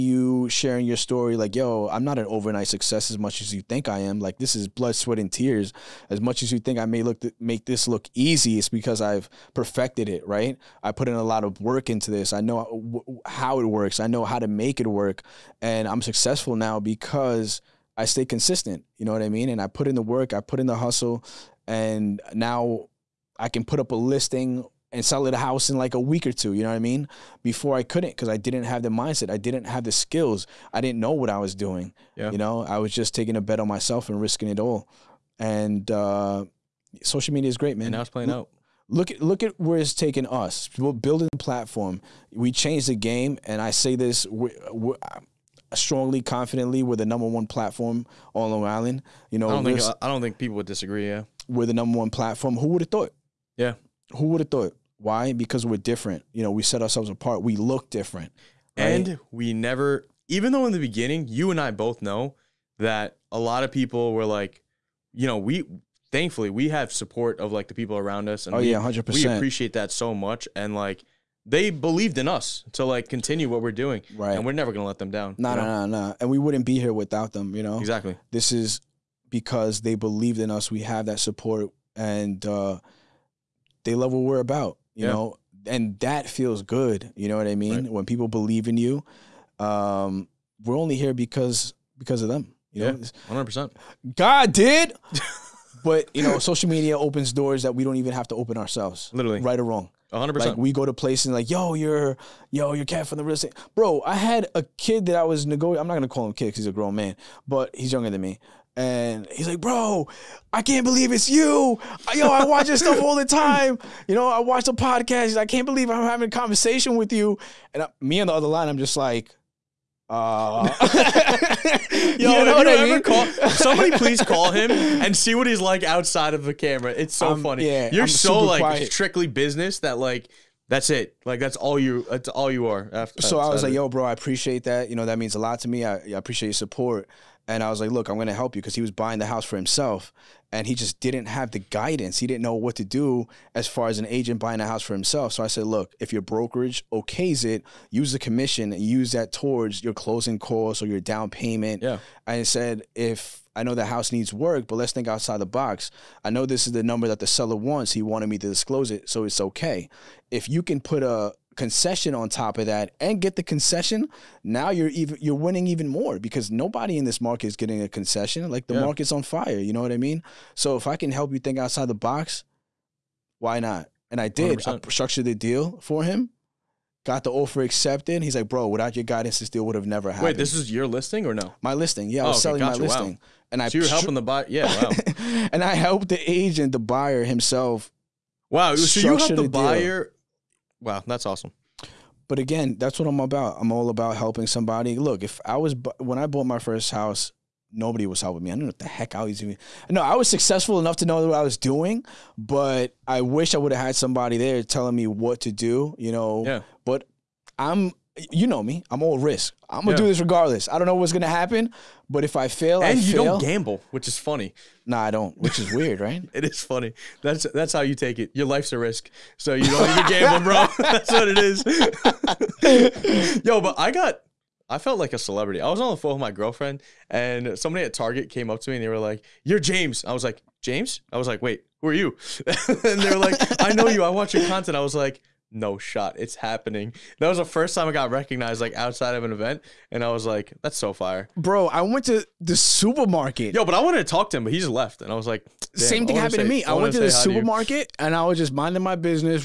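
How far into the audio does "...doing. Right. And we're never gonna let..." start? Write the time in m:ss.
1:13.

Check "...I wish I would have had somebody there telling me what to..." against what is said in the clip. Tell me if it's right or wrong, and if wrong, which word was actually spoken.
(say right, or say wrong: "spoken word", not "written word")
right.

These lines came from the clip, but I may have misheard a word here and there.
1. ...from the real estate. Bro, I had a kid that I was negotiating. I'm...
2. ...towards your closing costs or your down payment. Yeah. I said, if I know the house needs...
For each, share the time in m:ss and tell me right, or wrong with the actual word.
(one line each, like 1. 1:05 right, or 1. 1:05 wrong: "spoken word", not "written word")
1. 1:43 right
2. 2:29 right.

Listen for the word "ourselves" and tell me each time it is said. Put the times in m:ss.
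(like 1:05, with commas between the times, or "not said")
0:56, 1:38.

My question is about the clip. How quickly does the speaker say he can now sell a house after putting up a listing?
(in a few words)
a week or two.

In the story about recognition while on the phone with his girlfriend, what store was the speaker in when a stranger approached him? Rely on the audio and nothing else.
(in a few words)
Target.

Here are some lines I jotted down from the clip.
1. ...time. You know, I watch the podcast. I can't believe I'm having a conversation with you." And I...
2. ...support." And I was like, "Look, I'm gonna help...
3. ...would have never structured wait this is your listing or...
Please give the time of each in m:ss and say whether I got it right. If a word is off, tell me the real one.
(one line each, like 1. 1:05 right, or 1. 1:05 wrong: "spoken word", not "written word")
1. 1:53 right
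2. 2:16 right
3. 2:59 wrong: "happened", not "structured".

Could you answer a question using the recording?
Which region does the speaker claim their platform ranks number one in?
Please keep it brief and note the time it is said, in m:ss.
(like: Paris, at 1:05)
Long Island, at 0:48.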